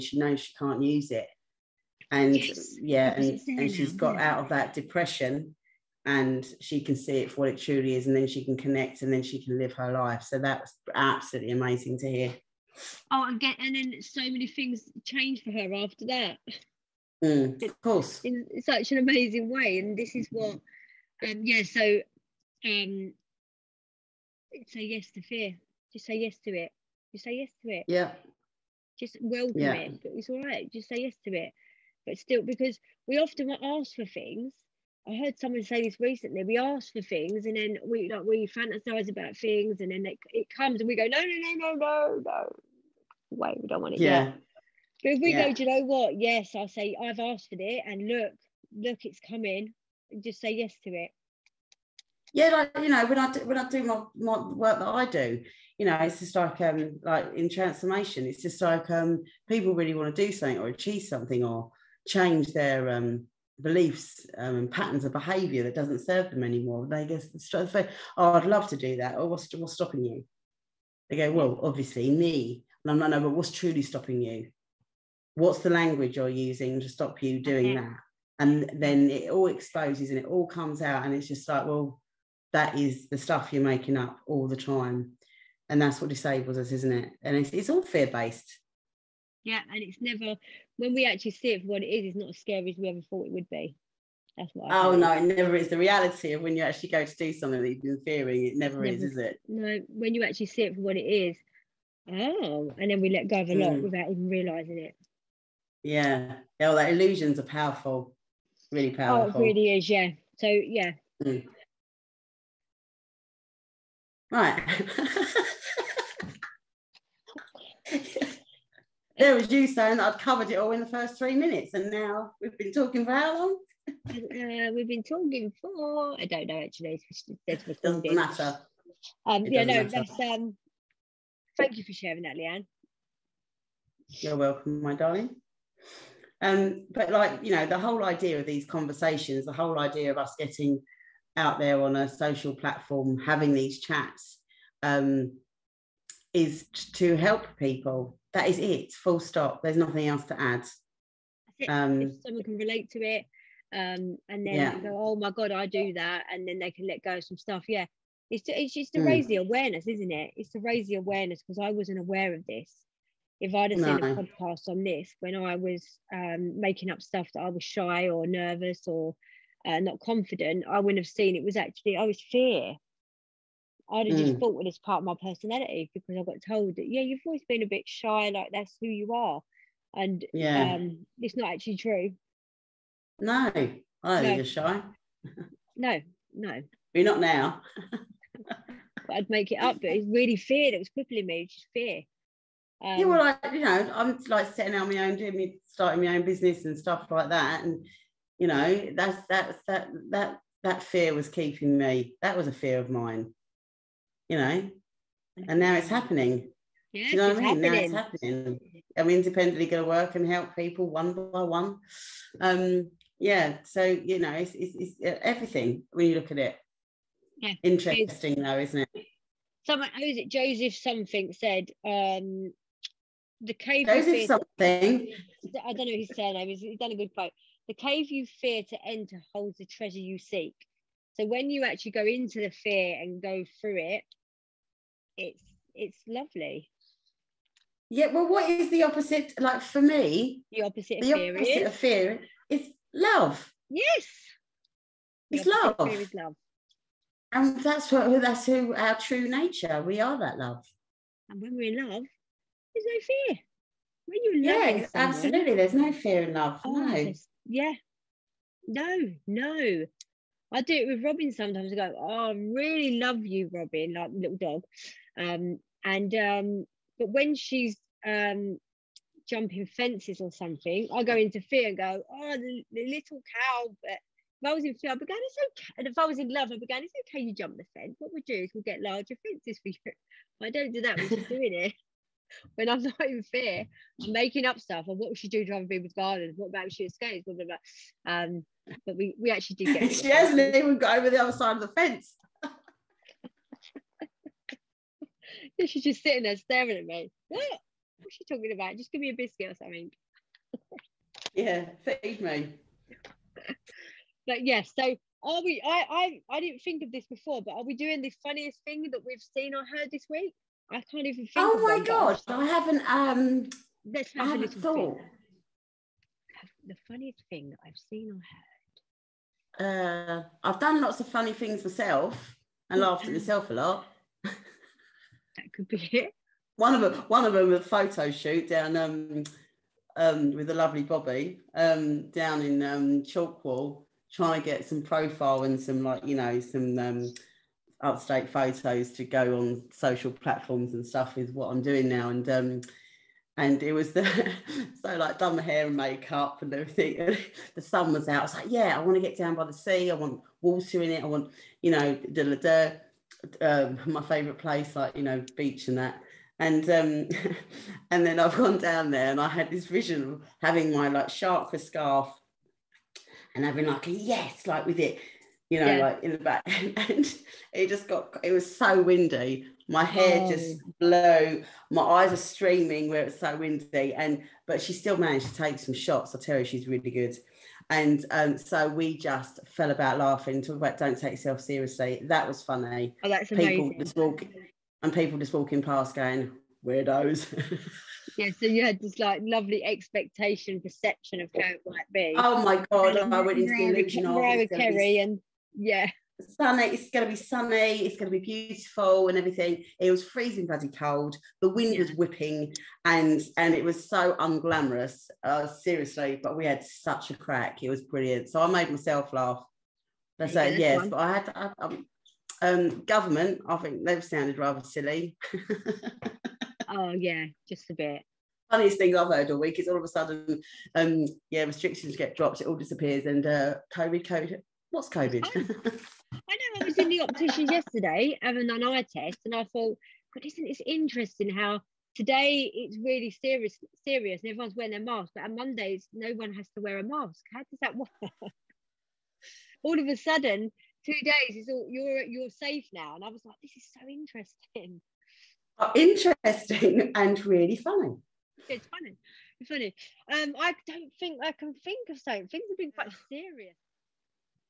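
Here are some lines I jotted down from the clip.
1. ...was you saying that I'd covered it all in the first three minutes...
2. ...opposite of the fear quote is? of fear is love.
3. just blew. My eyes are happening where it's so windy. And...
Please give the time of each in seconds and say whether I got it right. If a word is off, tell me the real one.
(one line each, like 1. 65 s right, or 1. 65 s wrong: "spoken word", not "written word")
1. 119 s right
2. 240 s wrong: "opposite", not "quote"
3. 370 s wrong: "streaming", not "happening".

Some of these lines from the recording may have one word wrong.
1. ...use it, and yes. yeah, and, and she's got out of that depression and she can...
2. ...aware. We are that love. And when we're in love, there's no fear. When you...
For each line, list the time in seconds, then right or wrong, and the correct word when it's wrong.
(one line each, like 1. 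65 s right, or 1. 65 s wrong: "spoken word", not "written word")
1. 0 s right
2. 249 s wrong: "nature", not "aware".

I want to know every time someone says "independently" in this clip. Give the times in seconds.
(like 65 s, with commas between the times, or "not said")
209 s.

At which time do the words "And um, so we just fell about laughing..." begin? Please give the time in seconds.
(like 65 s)
377 s.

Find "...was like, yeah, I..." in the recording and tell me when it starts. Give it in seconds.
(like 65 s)
348 s.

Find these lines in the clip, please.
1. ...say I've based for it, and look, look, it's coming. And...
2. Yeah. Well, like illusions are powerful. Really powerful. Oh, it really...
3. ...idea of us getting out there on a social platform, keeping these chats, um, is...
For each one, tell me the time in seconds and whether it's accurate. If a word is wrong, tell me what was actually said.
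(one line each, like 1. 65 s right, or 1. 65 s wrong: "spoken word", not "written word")
1. 46 s wrong: "asked", not "based"
2. 106 s right
3. 139 s wrong: "having", not "keeping".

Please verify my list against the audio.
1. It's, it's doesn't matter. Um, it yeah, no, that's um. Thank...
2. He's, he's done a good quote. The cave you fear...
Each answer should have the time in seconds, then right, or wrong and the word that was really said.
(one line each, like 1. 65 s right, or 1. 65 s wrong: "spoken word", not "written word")
1. 127 s right
2. 226 s right.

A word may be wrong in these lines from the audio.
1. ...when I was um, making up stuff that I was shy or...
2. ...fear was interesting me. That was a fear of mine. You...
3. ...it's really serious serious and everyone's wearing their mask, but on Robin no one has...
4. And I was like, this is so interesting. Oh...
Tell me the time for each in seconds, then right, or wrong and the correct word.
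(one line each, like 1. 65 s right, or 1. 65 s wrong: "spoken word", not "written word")
1. 165 s right
2. 200 s wrong: "keeping", not "interesting"
3. 432 s wrong: "Mondays", not "Robin"
4. 442 s right.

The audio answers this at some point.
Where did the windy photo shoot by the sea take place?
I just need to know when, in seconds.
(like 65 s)
333 s.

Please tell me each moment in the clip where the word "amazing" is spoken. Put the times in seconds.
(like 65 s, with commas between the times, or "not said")
11 s, 18 s, 383 s.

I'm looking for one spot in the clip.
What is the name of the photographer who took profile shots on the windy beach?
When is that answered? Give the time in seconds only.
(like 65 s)
330 s.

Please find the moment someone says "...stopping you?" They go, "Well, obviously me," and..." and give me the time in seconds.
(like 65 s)
69 s.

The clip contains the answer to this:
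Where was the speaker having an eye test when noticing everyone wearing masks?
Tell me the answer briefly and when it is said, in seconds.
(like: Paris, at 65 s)
The optician, at 426 s.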